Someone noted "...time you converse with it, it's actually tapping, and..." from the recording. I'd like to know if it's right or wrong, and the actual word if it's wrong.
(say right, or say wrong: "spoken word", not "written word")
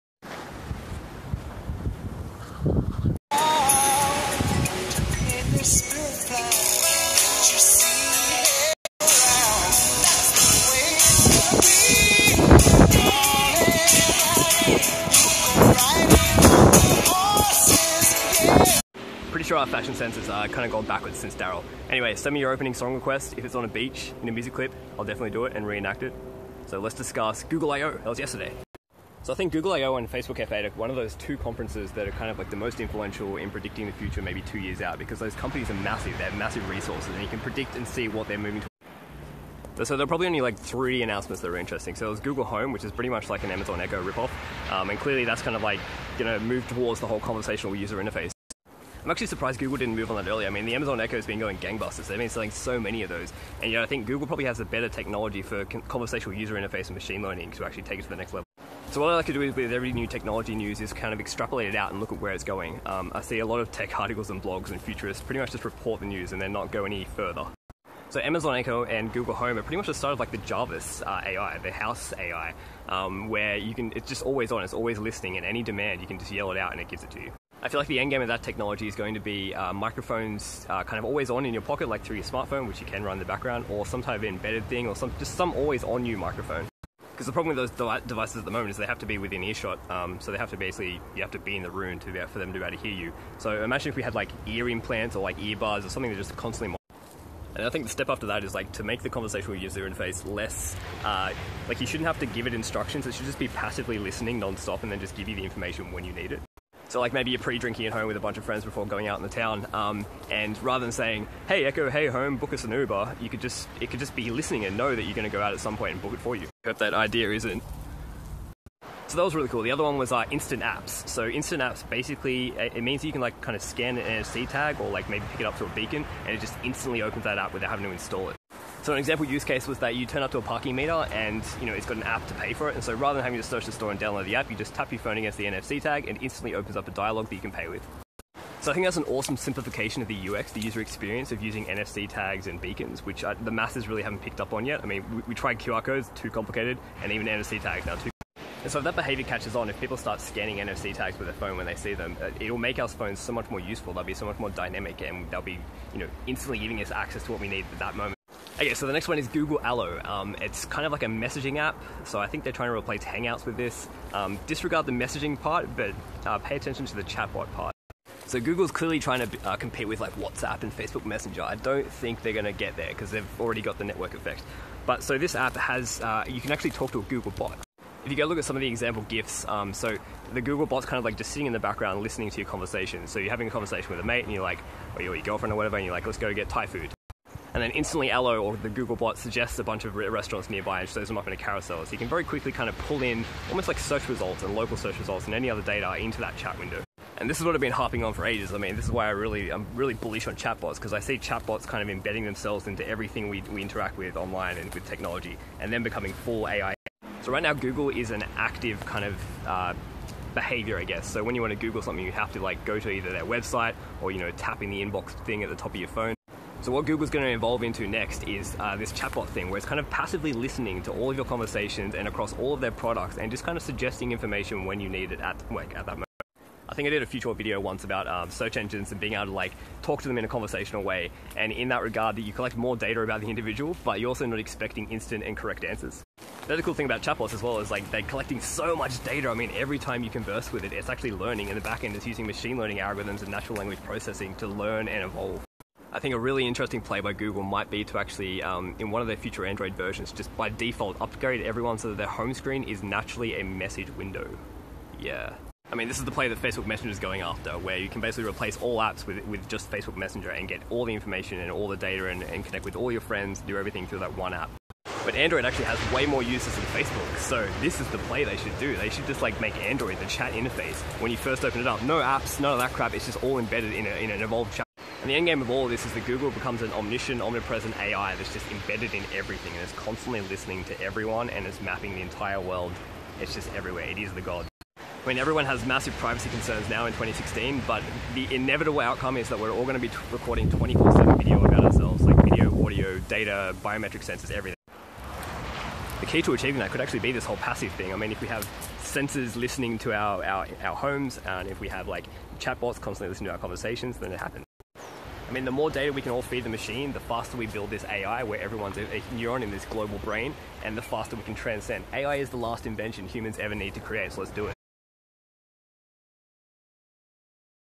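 wrong: "learning", not "tapping".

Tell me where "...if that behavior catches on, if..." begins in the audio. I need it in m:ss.
2:28.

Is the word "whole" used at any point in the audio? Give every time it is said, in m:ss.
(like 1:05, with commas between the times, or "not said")
0:47, 4:57.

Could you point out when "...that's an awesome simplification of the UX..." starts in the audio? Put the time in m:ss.
2:18.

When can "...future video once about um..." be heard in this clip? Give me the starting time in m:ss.
3:47.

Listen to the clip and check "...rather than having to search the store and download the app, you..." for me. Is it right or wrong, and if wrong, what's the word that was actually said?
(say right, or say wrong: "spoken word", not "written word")
right.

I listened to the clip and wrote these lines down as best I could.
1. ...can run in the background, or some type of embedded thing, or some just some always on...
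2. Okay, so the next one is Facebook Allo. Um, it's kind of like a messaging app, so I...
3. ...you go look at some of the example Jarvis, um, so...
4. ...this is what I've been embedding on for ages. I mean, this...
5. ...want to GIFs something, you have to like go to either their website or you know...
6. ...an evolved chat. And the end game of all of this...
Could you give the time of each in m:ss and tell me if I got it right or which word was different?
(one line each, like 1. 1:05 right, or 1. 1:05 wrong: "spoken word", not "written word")
1. 1:22 right
2. 2:38 wrong: "Google", not "Facebook"
3. 2:58 wrong: "GIFs", not "Jarvis"
4. 3:17 wrong: "harping", not "embedding"
5. 3:31 wrong: "Google", not "GIFs"
6. 4:34 right.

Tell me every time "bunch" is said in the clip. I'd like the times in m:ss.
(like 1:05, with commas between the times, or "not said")
1:48, 3:09.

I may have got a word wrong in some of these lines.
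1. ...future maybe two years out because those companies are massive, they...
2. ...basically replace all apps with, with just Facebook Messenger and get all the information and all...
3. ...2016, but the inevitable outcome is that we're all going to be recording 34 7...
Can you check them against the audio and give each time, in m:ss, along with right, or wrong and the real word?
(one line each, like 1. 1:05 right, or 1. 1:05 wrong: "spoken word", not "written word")
1. 0:33 right
2. 4:18 right
3. 4:46 wrong: "24", not "34".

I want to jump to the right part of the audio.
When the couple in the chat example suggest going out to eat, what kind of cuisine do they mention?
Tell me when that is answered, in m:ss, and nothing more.
3:06.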